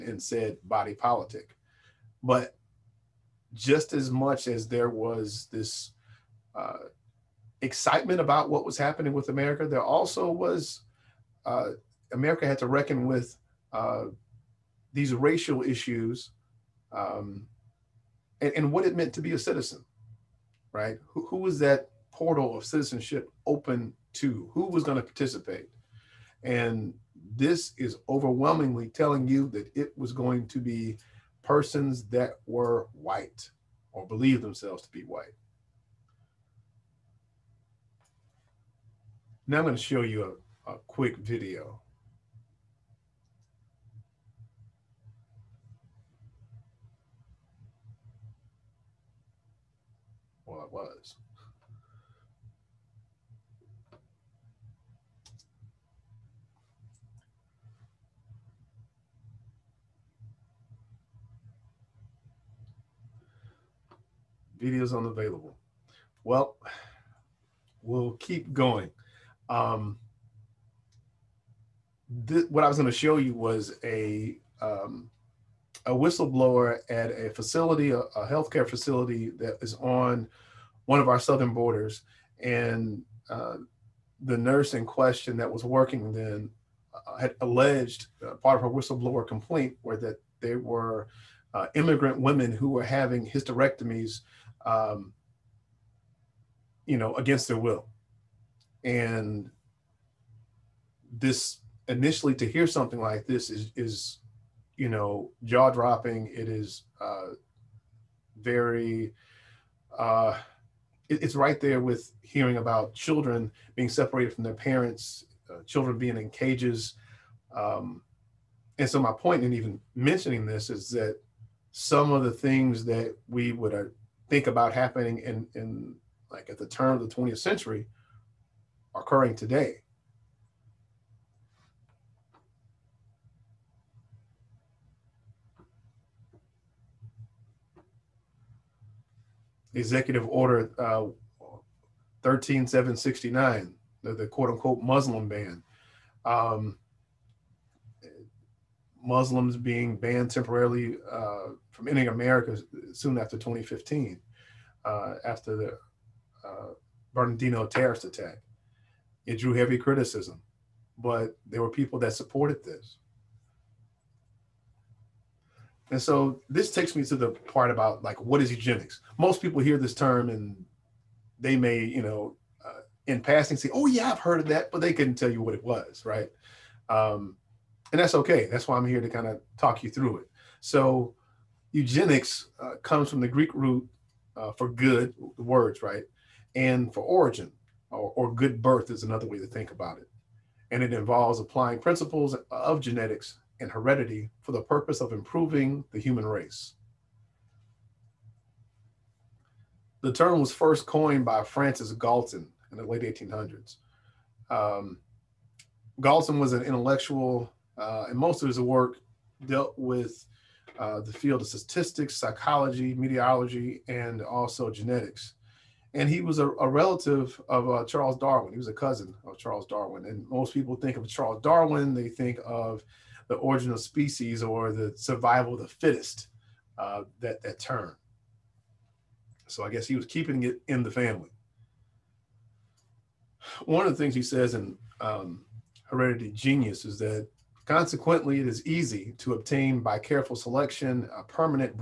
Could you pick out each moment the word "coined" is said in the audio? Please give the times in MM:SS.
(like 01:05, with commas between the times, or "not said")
03:20.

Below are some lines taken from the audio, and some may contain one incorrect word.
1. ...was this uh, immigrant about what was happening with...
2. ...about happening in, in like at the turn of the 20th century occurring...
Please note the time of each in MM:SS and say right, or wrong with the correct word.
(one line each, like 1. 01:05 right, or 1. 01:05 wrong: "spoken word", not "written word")
1. 00:04 wrong: "excitement", not "immigrant"
2. 02:04 right.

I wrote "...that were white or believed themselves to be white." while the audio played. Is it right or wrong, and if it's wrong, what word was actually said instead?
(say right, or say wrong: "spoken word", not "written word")
right.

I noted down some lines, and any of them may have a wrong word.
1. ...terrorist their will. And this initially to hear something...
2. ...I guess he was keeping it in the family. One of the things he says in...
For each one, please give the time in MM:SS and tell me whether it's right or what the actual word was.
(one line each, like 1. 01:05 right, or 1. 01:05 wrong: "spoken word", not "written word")
1. 01:37 wrong: "against", not "terrorist"
2. 03:49 right.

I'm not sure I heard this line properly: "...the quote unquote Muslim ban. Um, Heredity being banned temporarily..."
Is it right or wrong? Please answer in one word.
wrong.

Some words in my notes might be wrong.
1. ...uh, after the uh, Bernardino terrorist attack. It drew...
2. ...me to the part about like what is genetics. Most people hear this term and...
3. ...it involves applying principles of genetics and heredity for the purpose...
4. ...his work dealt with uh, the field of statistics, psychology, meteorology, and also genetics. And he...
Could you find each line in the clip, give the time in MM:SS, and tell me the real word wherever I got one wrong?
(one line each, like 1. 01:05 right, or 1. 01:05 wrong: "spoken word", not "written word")
1. 02:34 right
2. 02:46 wrong: "eugenics", not "genetics"
3. 03:10 right
4. 03:28 right.